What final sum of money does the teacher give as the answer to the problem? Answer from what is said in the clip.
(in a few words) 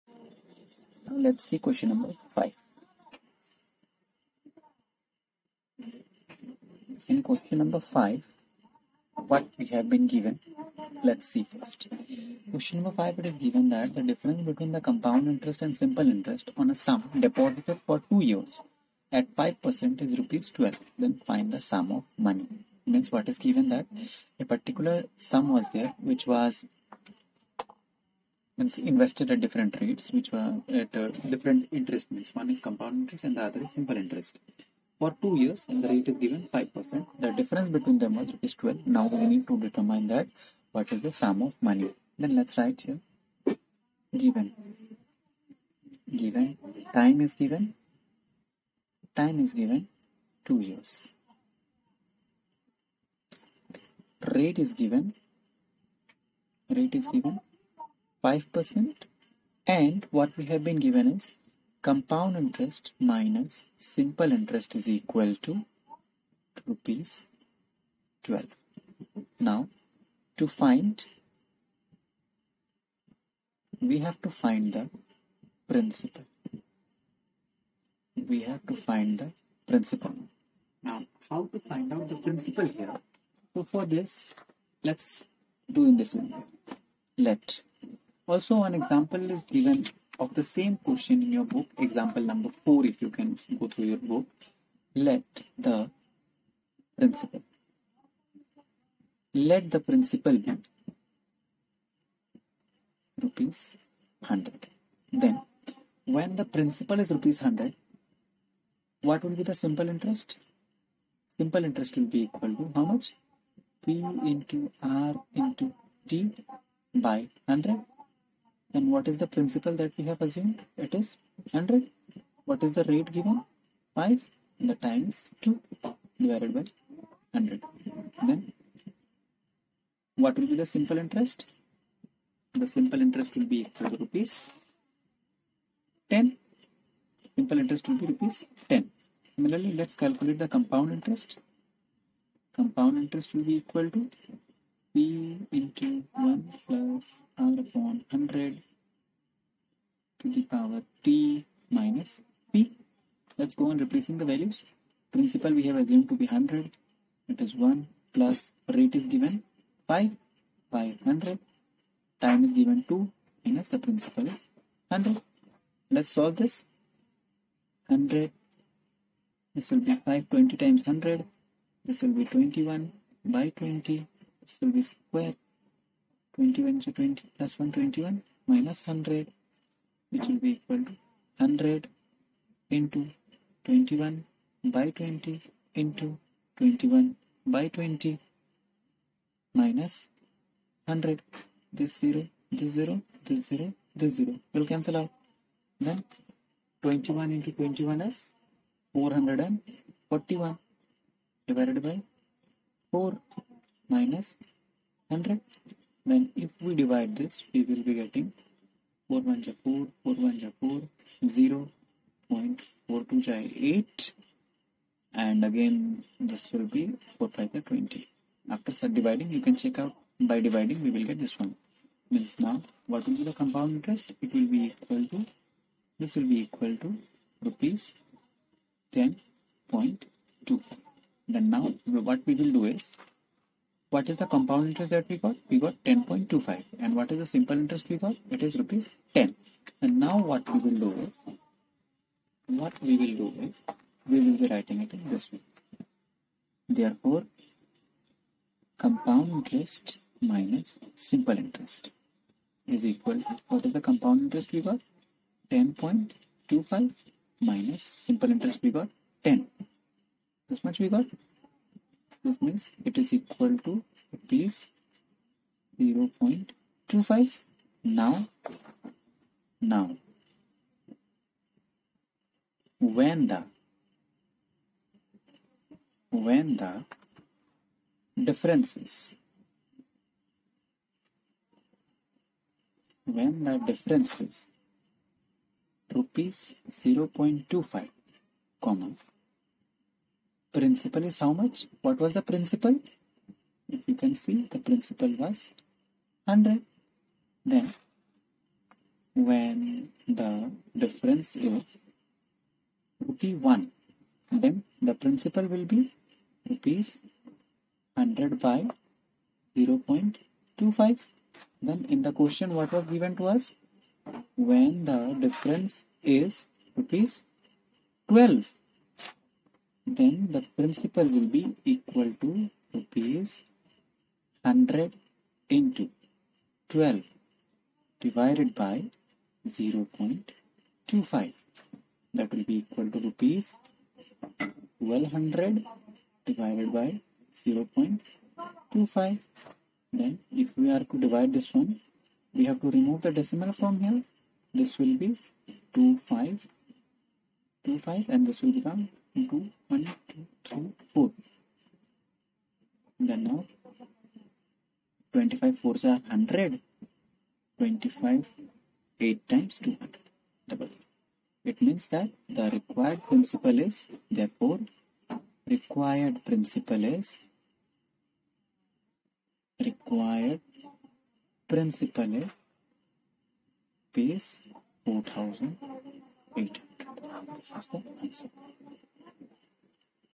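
Rs 4800.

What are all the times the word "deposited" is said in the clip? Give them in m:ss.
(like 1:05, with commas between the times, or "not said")
0:17.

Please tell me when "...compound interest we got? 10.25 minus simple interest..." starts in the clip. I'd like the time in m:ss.
4:13.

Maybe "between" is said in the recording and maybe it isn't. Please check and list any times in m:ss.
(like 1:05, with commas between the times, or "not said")
0:14, 0:37.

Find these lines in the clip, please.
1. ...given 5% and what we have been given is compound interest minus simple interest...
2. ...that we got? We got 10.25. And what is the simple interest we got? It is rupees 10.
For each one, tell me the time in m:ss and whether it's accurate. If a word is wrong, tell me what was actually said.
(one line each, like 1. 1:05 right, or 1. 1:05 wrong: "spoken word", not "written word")
1. 0:57 right
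2. 3:54 right.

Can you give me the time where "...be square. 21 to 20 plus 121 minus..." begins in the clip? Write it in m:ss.
2:54.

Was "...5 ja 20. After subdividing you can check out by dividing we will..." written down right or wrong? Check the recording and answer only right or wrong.
right.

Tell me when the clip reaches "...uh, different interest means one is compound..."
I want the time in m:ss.
0:30.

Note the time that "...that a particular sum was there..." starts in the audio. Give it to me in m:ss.
0:23.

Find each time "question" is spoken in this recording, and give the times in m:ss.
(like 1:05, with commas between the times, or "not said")
0:01, 0:07, 0:12, 1:30, 5:12.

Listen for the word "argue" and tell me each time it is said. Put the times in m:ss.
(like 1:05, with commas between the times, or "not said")
not said.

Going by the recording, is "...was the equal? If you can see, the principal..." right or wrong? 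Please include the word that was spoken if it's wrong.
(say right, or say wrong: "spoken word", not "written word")
wrong: "principal", not "equal".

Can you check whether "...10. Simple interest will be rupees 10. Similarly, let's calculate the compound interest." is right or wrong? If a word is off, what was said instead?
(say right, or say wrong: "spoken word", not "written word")
right.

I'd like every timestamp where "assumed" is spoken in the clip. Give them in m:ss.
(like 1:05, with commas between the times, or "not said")
2:00, 2:35.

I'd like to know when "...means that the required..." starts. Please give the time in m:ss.
6:01.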